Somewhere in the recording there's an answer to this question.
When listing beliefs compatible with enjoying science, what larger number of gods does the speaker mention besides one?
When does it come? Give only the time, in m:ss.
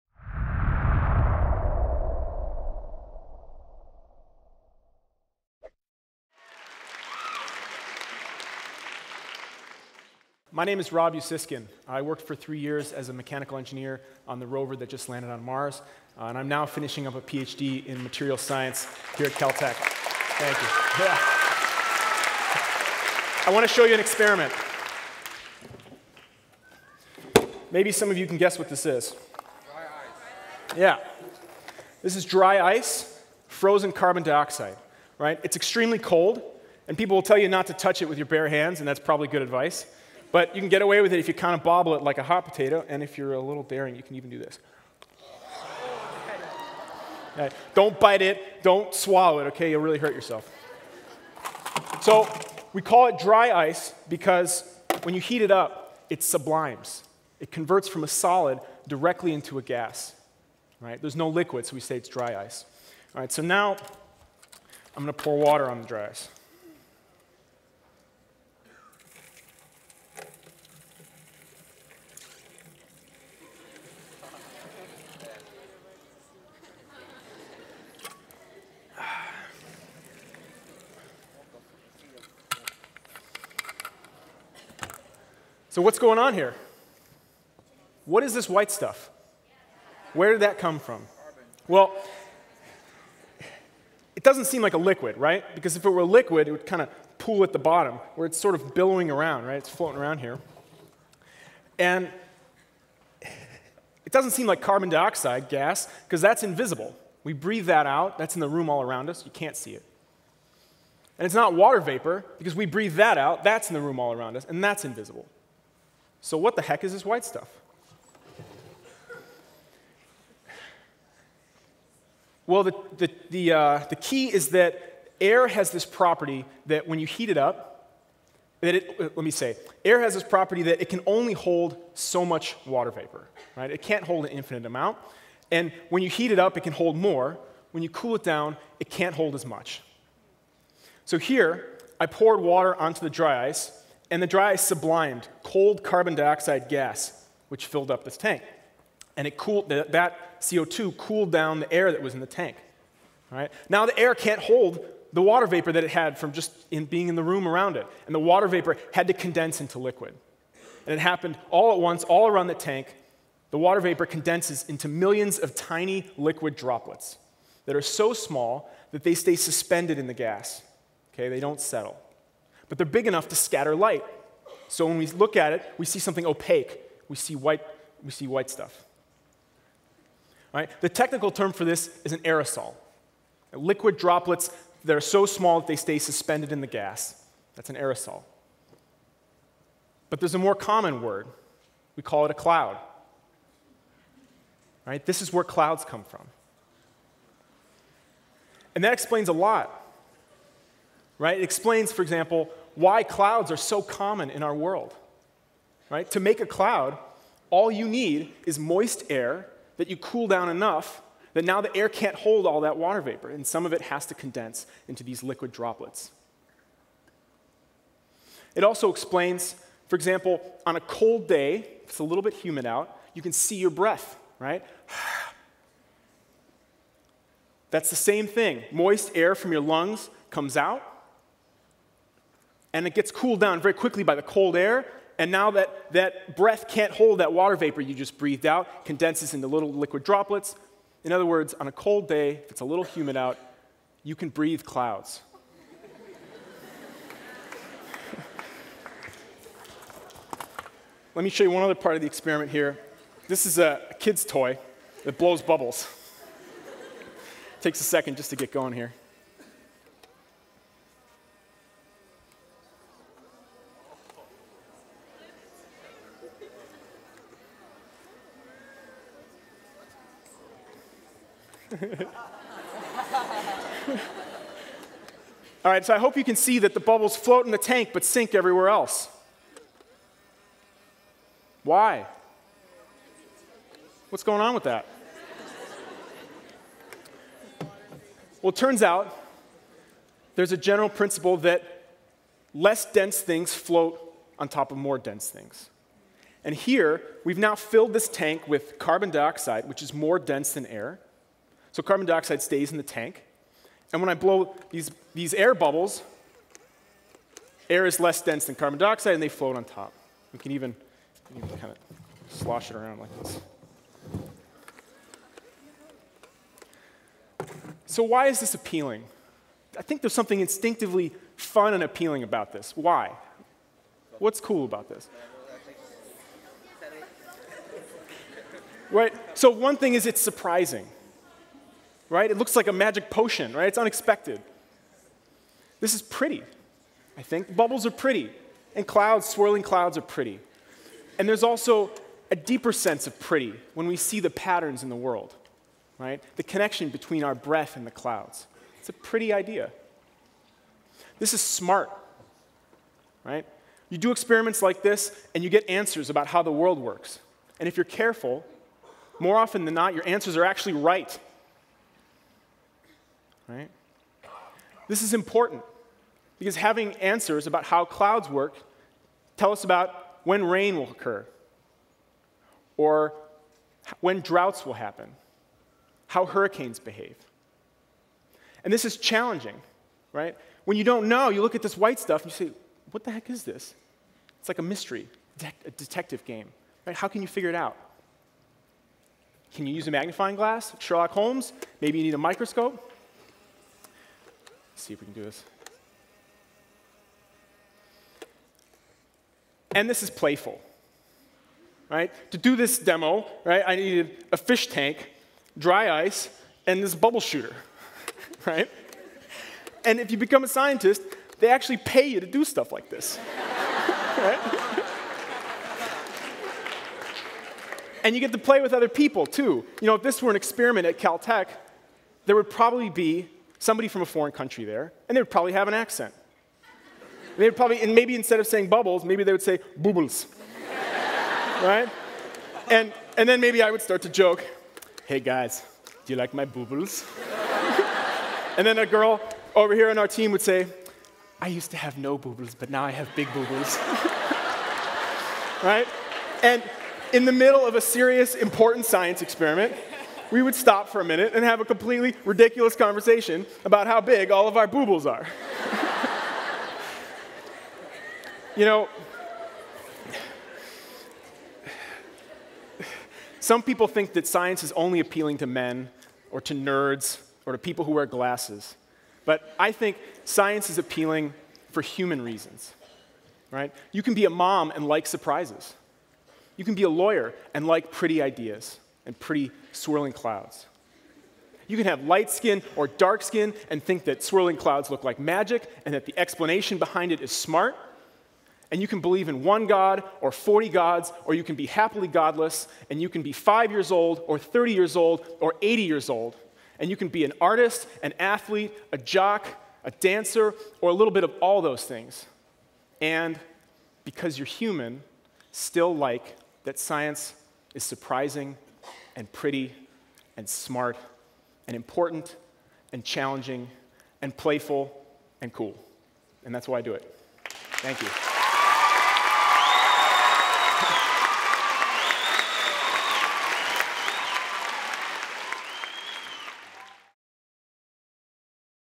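8:10.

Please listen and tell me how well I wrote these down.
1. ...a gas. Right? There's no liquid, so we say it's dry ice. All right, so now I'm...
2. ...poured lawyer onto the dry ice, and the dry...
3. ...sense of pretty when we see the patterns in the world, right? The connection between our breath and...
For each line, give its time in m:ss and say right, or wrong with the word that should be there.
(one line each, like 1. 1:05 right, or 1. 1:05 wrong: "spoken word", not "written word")
1. 0:59 right
2. 2:22 wrong: "water", not "lawyer"
3. 5:42 right.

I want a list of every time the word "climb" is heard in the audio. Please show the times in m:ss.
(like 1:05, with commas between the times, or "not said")
not said.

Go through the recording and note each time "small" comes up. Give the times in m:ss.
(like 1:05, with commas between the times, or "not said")
2:48, 3:05.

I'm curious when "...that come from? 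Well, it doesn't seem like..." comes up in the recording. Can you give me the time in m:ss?
1:30.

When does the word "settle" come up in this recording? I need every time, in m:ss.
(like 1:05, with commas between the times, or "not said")
2:51.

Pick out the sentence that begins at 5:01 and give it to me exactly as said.
So carbon dioxide stays in the tank.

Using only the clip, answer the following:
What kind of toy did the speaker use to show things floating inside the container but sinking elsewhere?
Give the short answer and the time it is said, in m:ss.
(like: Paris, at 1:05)
Kid's toy that blows bubbles, at 6:46.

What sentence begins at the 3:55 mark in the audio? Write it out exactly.
And now that, that breath can't hold that water vapor you just breathed out, condenses into little liquid droplets.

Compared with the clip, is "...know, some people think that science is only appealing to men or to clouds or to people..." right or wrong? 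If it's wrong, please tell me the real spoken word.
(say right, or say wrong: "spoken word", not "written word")
wrong: "nerds", not "clouds".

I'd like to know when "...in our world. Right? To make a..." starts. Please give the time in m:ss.
3:24.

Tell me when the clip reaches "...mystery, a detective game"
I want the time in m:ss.
6:24.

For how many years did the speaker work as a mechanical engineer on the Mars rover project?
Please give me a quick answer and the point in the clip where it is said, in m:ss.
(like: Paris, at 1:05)
3, at 0:12.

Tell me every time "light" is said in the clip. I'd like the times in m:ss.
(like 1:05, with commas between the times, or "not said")
2:53, 8:02.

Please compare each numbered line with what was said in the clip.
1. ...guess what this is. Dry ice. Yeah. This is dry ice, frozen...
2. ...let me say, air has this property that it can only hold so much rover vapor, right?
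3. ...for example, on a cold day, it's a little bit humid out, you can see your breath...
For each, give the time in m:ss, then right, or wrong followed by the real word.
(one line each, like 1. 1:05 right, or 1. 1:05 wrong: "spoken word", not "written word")
1. 0:28 right
2. 2:09 wrong: "water", not "rover"
3. 3:39 right.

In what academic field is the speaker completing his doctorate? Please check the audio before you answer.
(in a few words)
Material science.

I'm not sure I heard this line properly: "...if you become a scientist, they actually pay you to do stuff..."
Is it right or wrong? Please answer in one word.
right.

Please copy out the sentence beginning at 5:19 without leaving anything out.
I think there's something instinctively fun and appealing about this.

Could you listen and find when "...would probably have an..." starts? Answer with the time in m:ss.
7:05.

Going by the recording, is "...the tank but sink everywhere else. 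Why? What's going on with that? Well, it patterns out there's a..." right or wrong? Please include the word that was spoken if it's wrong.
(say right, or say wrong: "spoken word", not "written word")
wrong: "turns", not "patterns".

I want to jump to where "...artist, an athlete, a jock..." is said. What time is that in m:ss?
8:17.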